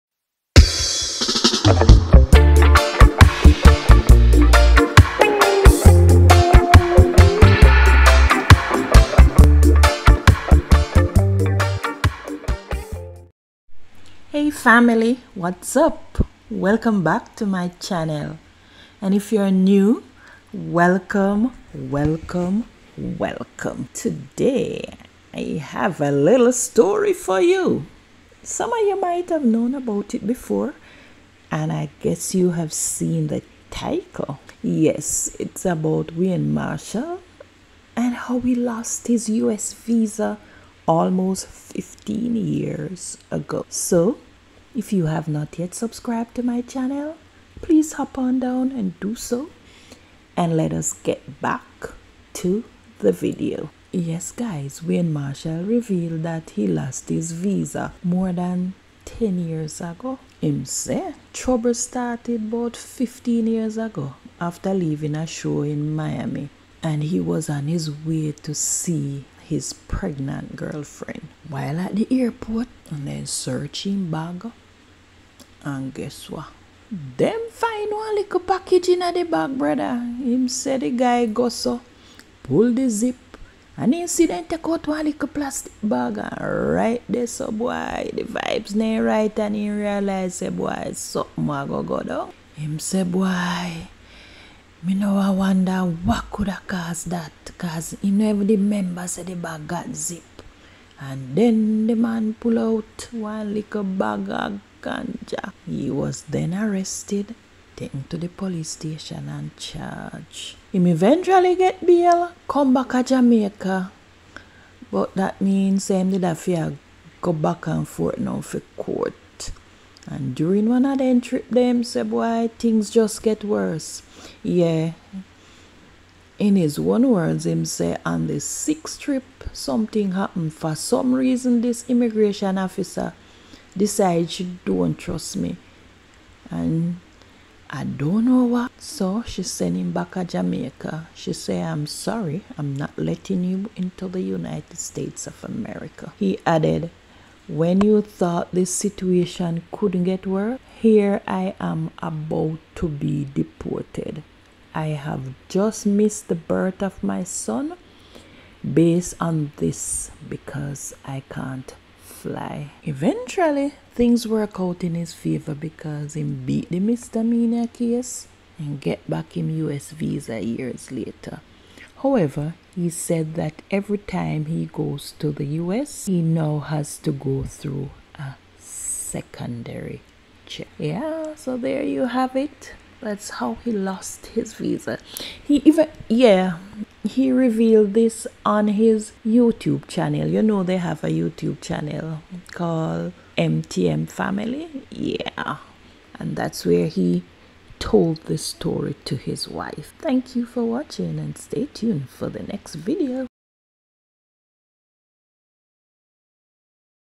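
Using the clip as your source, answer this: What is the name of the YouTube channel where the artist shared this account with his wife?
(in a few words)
MTM Family.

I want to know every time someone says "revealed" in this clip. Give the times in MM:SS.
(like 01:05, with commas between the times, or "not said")
00:55, 03:07.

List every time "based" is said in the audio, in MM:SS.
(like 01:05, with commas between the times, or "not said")
02:38.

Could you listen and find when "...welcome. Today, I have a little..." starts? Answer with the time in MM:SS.
00:22.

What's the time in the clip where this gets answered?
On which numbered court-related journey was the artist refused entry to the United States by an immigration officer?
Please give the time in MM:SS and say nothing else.
02:08.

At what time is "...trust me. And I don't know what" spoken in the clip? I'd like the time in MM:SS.
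02:14.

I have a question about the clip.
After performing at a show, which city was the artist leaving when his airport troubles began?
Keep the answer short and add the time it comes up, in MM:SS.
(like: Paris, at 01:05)
Miami, at 01:05.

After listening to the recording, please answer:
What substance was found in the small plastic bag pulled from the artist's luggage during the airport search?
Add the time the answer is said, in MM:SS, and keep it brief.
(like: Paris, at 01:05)
ganja, at 01:44.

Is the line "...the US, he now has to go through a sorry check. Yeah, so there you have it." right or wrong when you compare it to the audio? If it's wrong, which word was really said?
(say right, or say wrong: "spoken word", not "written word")
wrong: "secondary", not "sorry".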